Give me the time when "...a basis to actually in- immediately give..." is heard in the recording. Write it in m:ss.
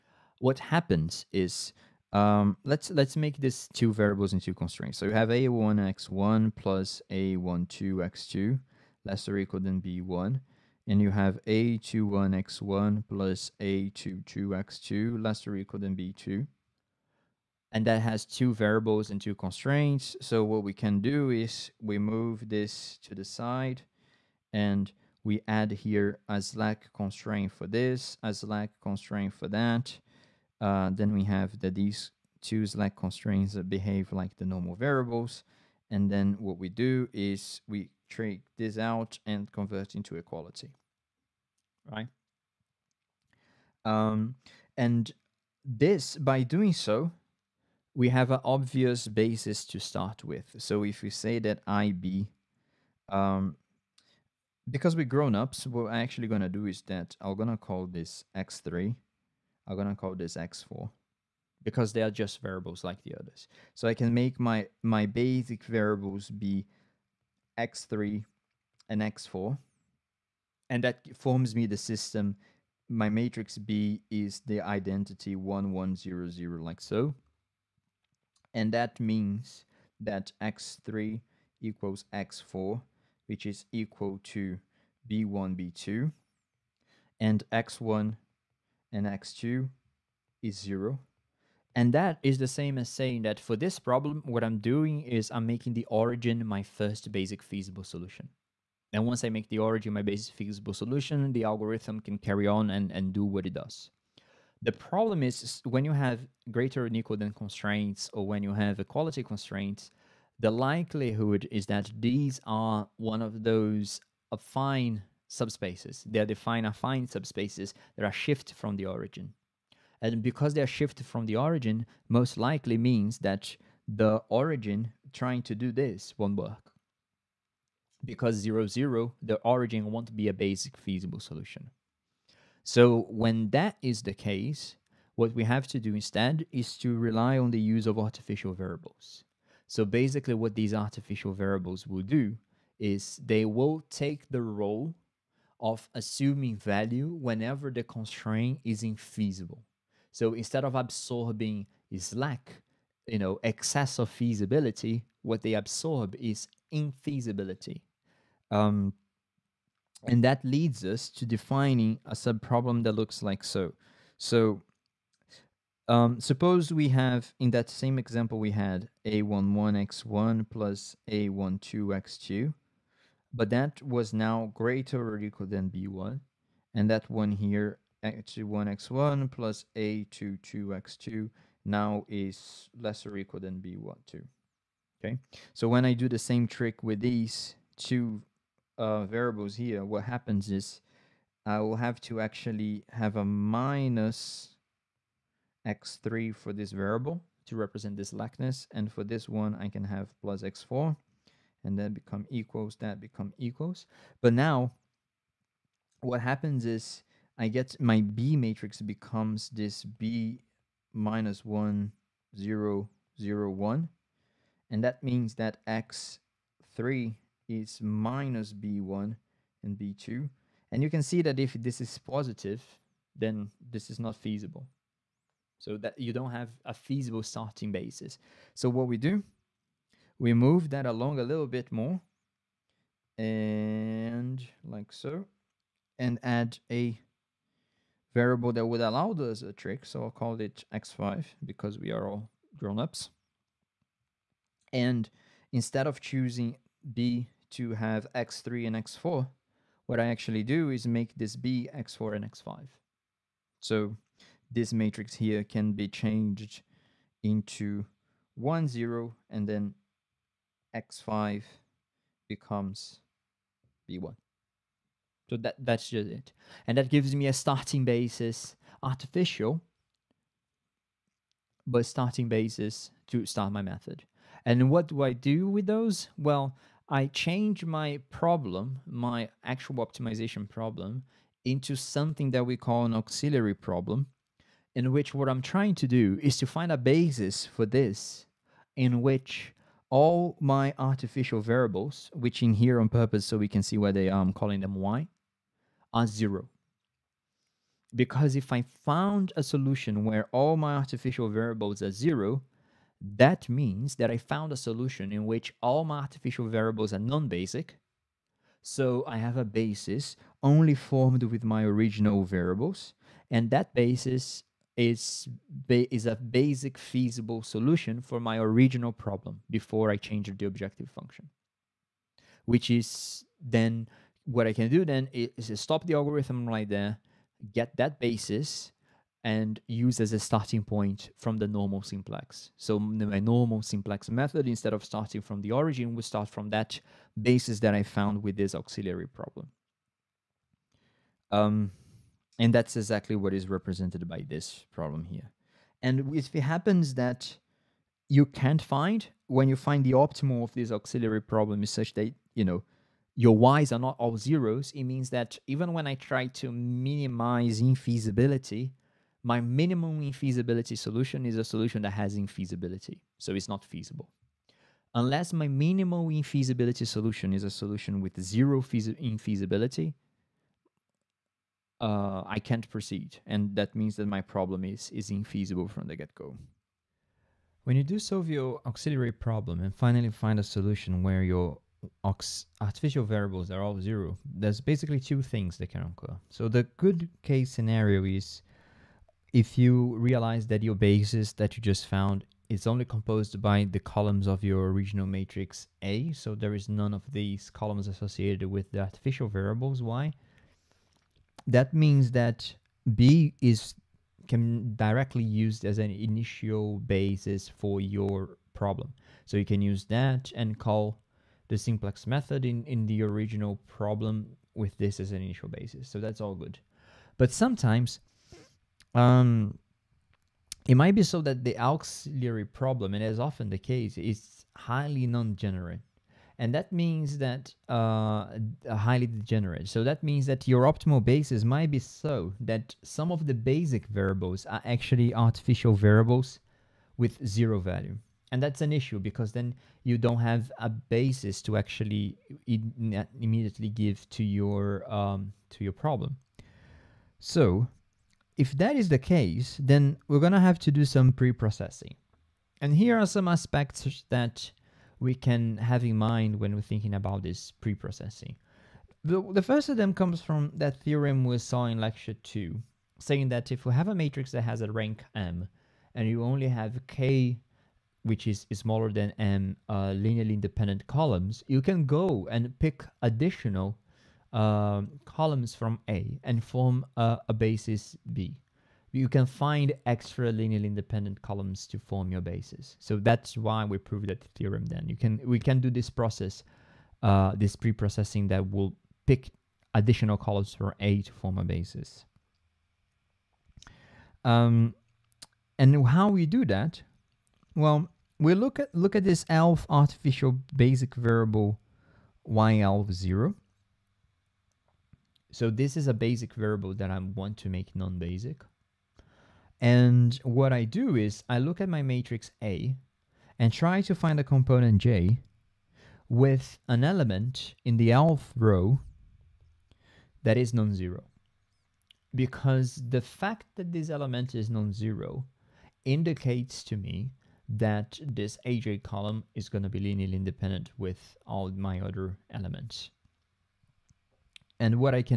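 7:20.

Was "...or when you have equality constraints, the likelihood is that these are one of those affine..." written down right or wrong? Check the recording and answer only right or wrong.
right.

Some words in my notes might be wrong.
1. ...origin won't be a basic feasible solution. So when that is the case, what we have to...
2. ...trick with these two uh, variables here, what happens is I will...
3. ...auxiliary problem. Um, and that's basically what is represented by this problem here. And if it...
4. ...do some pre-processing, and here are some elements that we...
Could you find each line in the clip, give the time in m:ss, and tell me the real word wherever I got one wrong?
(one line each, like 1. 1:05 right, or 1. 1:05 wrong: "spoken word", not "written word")
1. 2:09 right
2. 3:06 right
3. 5:38 wrong: "exactly", not "basically"
4. 7:30 wrong: "aspects", not "elements".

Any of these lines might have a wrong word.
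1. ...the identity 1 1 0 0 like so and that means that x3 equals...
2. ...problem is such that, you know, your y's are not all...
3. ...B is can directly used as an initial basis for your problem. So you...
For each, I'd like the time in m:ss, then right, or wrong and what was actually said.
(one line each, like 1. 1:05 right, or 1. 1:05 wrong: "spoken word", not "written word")
1. 1:14 right
2. 5:51 right
3. 6:42 right.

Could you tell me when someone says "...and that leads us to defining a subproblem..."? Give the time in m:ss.
2:40.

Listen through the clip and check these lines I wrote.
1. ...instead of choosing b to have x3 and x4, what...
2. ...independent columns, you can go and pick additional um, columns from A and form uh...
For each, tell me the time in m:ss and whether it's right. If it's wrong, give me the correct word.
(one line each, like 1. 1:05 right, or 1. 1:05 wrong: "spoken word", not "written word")
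1. 4:05 right
2. 7:50 right.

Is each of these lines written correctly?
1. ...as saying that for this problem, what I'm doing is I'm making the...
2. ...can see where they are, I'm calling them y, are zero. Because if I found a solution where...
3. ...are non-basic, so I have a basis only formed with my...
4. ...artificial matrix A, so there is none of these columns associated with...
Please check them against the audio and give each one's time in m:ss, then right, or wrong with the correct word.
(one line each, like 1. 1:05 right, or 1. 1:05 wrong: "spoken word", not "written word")
1. 1:32 right
2. 4:53 right
3. 5:06 right
4. 6:34 wrong: "original", not "artificial".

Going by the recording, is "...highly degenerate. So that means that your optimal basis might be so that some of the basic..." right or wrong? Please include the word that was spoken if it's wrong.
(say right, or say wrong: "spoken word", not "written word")
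right.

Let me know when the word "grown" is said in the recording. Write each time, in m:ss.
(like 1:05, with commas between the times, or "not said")
0:55, 4:02.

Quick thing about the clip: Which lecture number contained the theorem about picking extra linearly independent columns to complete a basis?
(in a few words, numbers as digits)
2.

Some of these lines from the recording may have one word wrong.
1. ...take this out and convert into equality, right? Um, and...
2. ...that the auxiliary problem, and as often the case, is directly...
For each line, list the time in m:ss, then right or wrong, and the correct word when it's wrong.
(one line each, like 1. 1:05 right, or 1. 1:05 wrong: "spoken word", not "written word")
1. 0:38 right
2. 7:01 wrong: "highly", not "directly".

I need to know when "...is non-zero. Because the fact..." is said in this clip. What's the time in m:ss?
8:40.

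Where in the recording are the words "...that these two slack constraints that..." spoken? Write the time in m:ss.
0:31.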